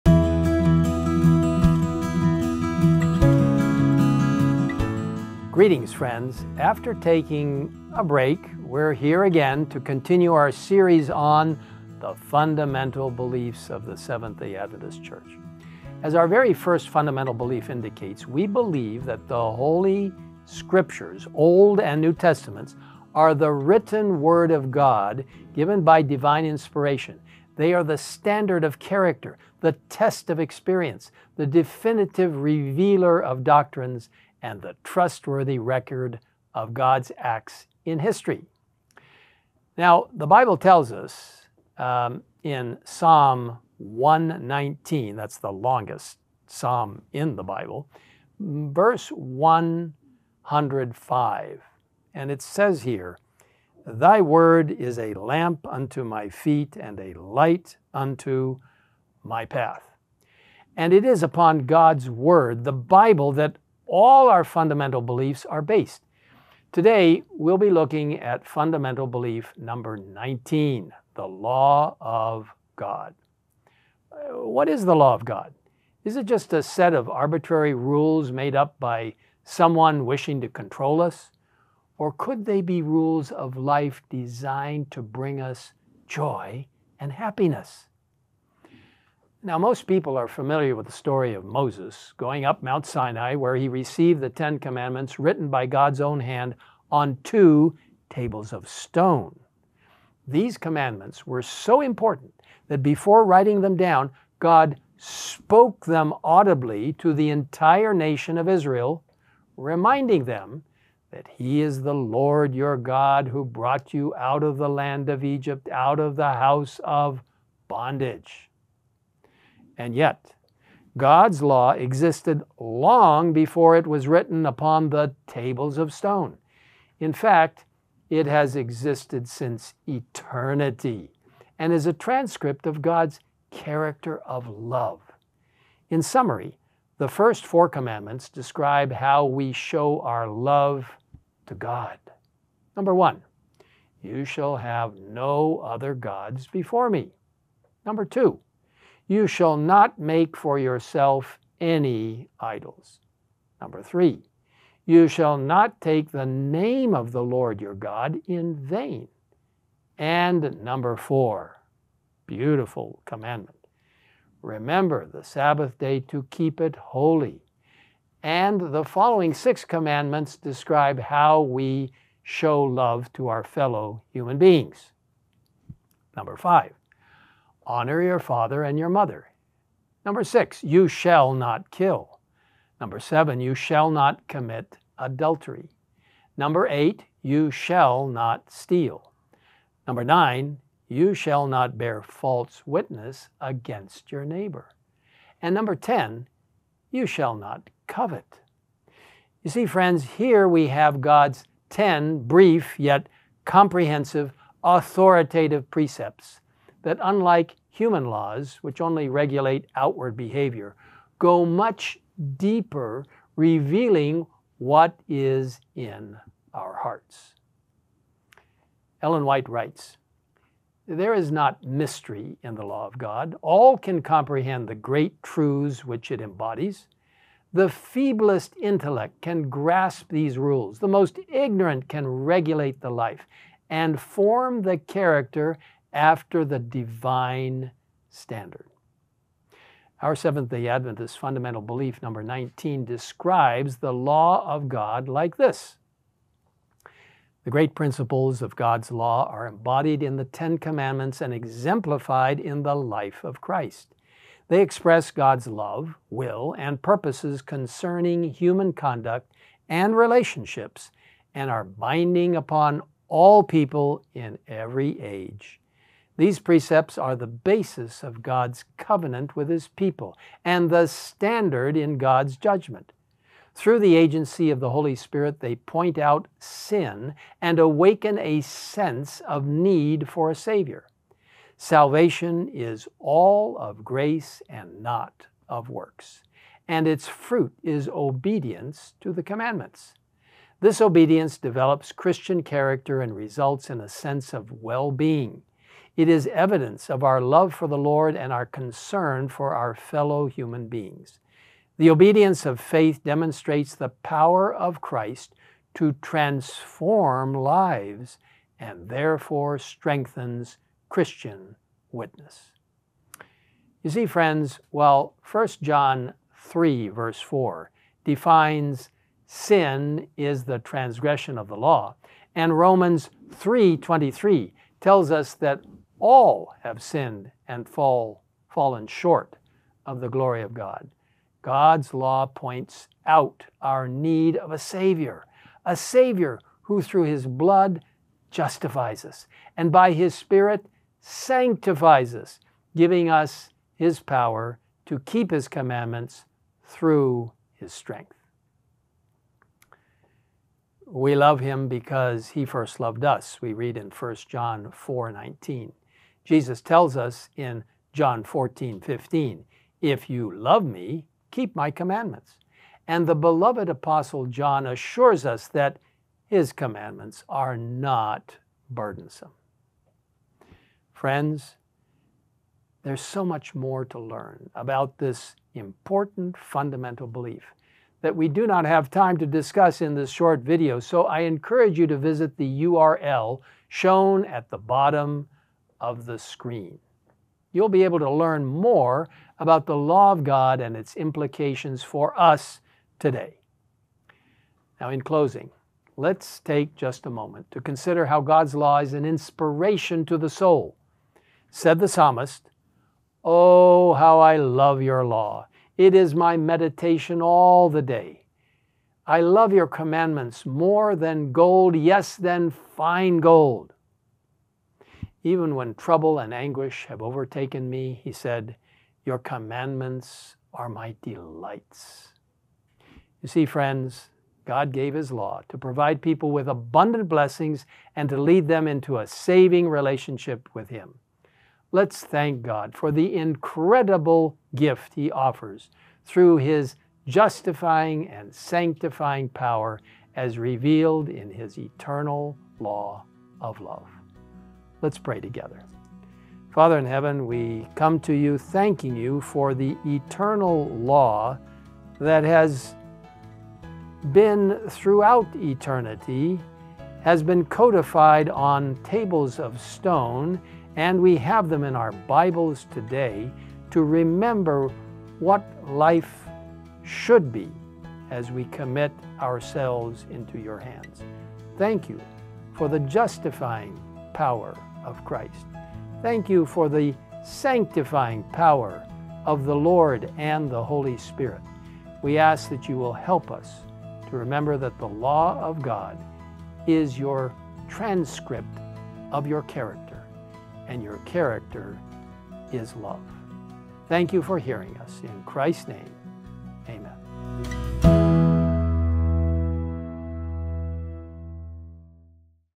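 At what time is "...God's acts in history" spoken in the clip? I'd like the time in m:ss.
0:36.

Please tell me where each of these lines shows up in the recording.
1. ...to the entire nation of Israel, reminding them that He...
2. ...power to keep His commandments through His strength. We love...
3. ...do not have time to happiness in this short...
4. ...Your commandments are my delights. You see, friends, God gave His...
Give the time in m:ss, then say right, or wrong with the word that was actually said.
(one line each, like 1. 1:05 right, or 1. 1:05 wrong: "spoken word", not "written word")
1. 1:46 right
2. 5:43 right
3. 6:18 wrong: "discuss", not "happiness"
4. 6:59 right.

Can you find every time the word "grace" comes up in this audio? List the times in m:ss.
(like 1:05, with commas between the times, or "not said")
4:43.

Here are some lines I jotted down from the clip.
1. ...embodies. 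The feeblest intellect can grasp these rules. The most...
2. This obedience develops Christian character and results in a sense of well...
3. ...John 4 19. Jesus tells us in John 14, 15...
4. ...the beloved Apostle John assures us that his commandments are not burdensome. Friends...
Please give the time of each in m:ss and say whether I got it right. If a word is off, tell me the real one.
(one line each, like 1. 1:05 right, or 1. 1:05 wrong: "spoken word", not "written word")
1. 3:46 right
2. 4:50 right
3. 5:54 right
4. 6:03 right.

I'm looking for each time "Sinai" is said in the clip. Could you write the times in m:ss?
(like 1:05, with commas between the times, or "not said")
1:32.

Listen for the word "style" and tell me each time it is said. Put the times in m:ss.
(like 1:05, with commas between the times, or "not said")
not said.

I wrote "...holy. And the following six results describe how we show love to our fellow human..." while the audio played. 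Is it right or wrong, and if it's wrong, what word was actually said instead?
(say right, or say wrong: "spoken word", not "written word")
wrong: "commandments", not "results".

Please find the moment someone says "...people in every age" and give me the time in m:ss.
4:23.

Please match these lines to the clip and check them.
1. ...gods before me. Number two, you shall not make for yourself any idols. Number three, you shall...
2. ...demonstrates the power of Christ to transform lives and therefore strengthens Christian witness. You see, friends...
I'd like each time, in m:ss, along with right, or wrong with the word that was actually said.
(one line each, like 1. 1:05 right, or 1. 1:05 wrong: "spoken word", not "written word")
1. 2:25 right
2. 5:03 right.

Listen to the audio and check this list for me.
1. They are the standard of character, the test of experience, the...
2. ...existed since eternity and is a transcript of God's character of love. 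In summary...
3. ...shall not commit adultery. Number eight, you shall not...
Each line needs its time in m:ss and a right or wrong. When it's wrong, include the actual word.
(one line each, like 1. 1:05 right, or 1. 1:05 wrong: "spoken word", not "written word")
1. 0:27 right
2. 2:08 right
3. 3:03 right.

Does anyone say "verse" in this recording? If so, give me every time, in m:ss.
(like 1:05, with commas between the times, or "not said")
0:48, 5:16.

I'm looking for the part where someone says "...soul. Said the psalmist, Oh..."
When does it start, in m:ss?
6:40.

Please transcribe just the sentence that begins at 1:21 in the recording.
Or could they be rules of life designed to bring us joy and happiness?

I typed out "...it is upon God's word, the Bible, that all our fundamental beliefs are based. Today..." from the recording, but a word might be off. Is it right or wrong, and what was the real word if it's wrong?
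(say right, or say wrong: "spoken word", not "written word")
right.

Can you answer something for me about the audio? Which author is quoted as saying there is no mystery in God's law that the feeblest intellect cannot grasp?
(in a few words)
Ellen White.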